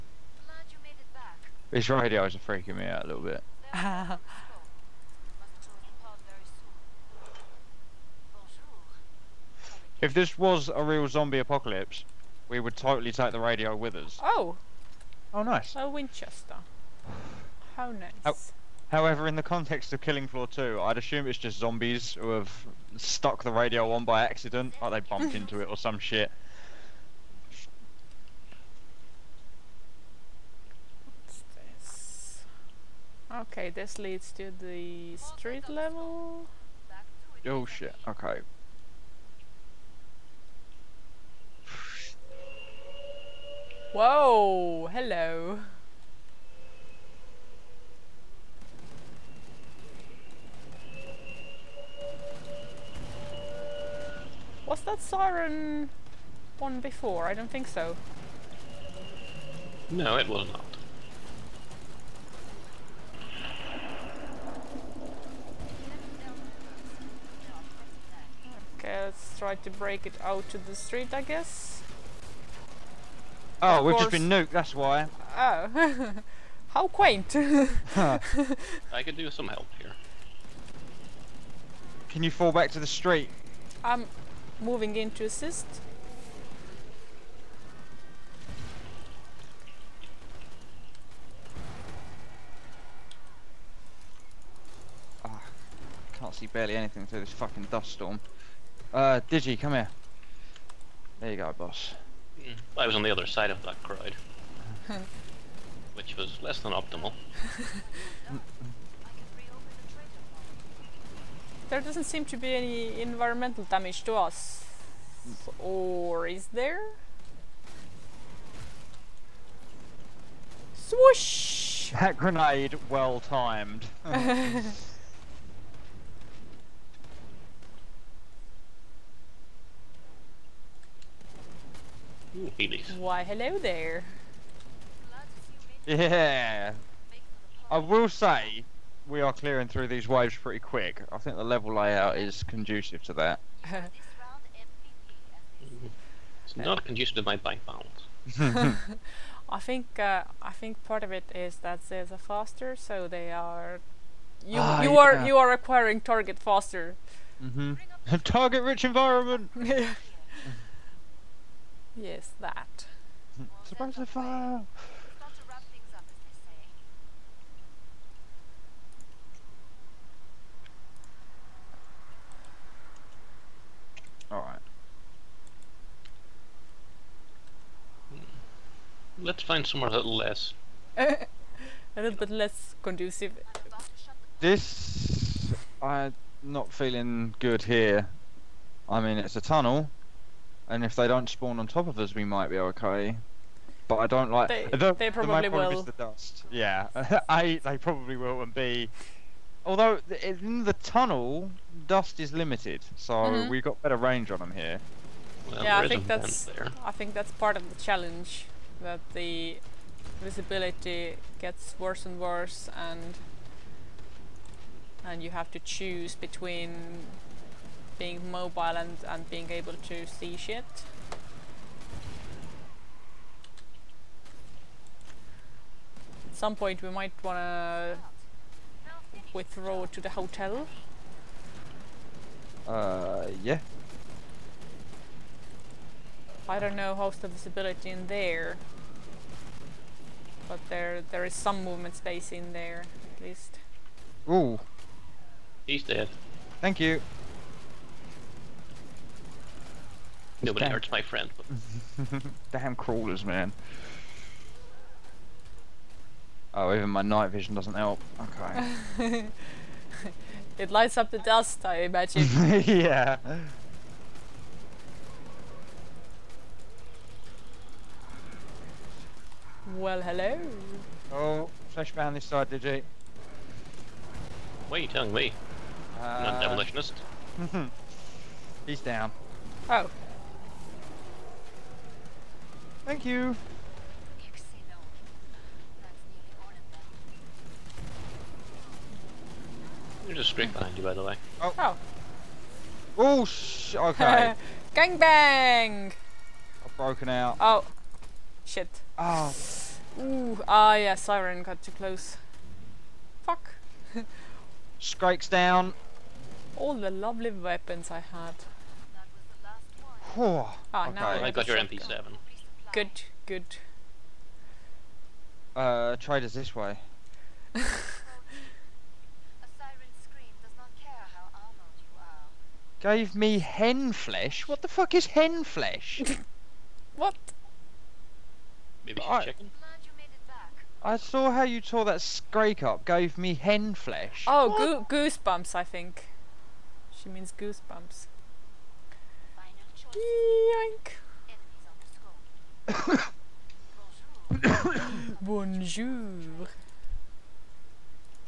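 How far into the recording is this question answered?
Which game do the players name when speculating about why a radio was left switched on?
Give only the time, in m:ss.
0:20.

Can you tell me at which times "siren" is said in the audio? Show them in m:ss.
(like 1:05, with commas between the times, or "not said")
0:55, 5:00.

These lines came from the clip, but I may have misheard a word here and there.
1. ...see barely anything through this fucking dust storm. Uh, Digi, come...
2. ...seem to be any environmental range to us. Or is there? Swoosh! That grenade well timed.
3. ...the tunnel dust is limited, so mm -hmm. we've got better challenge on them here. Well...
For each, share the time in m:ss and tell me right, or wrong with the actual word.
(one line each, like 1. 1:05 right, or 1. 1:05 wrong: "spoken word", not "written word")
1. 1:36 right
2. 1:52 wrong: "damage", not "range"
3. 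3:20 wrong: "range", not "challenge".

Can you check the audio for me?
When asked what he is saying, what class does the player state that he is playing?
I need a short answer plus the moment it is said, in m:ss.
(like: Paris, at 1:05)
Demolitionist, at 4:36.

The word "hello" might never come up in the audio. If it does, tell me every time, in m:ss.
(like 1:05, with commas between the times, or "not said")
0:44, 2:13, 4:30.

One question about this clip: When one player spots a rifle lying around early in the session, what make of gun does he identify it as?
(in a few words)
Winchester.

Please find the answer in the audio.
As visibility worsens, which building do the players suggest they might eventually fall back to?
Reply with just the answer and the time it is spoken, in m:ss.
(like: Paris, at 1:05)
The hotel, at 3:50.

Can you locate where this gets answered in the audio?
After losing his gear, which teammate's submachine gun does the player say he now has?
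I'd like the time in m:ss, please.
5:11.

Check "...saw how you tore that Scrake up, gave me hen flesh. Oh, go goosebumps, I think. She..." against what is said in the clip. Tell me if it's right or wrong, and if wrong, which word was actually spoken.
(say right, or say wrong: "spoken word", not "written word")
right.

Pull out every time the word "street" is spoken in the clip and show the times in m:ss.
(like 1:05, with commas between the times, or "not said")
0:35, 1:10, 1:22.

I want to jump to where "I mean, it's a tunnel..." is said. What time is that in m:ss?
3:08.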